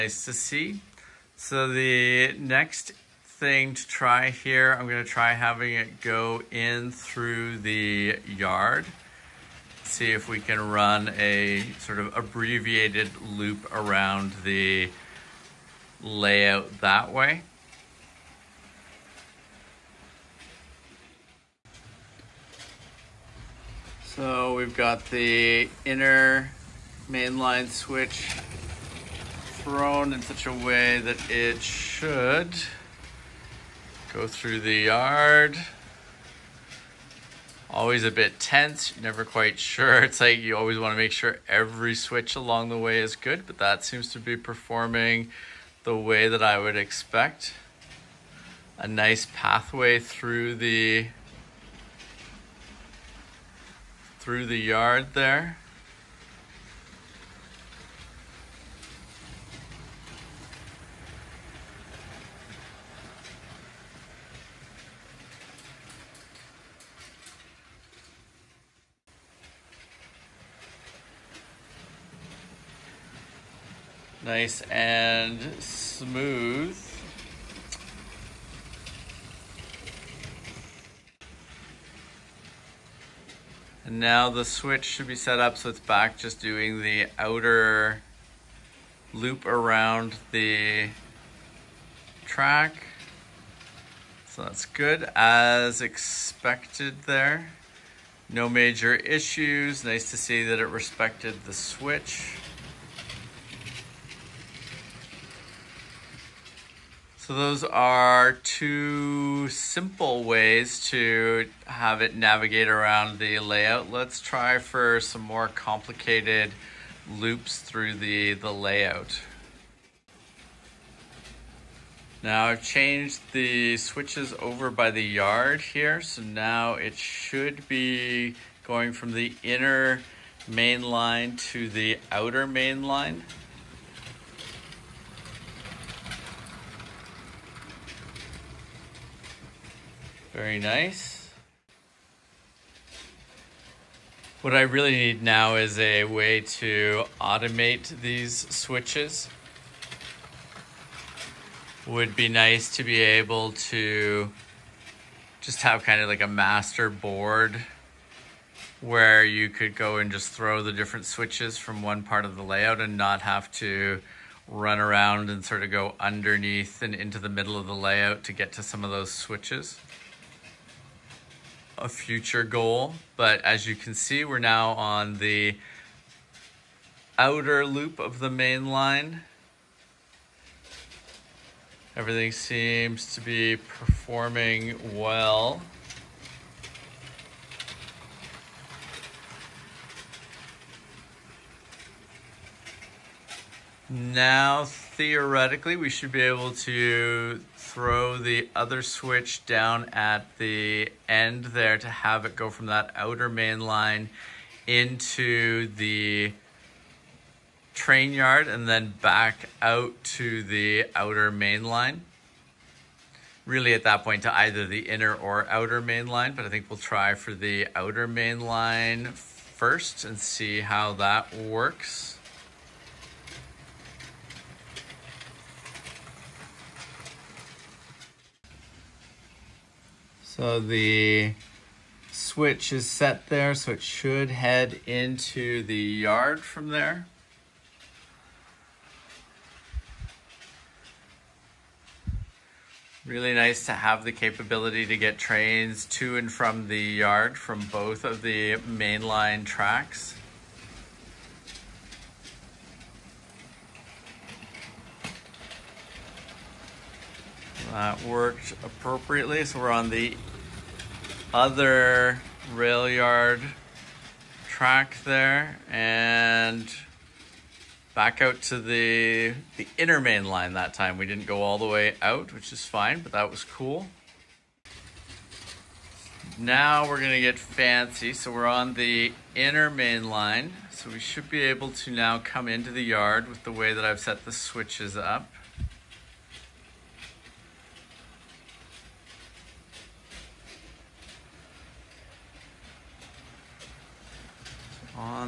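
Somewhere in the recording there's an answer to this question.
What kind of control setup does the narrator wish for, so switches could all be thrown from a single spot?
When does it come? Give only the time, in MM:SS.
02:36.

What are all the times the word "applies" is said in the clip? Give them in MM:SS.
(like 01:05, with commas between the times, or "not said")
not said.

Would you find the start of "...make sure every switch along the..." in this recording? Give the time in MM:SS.
00:40.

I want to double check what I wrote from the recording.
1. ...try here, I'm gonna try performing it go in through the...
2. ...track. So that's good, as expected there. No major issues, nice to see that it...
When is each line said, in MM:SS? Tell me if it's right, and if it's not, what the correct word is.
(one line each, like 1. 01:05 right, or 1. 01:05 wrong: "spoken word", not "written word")
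1. 00:03 wrong: "having", not "performing"
2. 01:32 right.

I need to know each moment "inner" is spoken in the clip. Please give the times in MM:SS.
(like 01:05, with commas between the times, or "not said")
00:25, 02:09, 03:34, 04:29, 04:39.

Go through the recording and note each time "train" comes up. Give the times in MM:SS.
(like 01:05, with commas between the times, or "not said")
03:27, 04:05.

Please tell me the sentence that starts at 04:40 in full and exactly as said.
So we should be able to now come into the yard with the way that I've set the switches up.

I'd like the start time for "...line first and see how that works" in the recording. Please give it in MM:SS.
03:38.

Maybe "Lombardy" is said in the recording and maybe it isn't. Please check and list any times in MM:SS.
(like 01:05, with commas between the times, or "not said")
not said.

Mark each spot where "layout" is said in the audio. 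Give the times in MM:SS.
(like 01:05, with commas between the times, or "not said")
00:16, 01:53, 01:58, 02:42, 02:47.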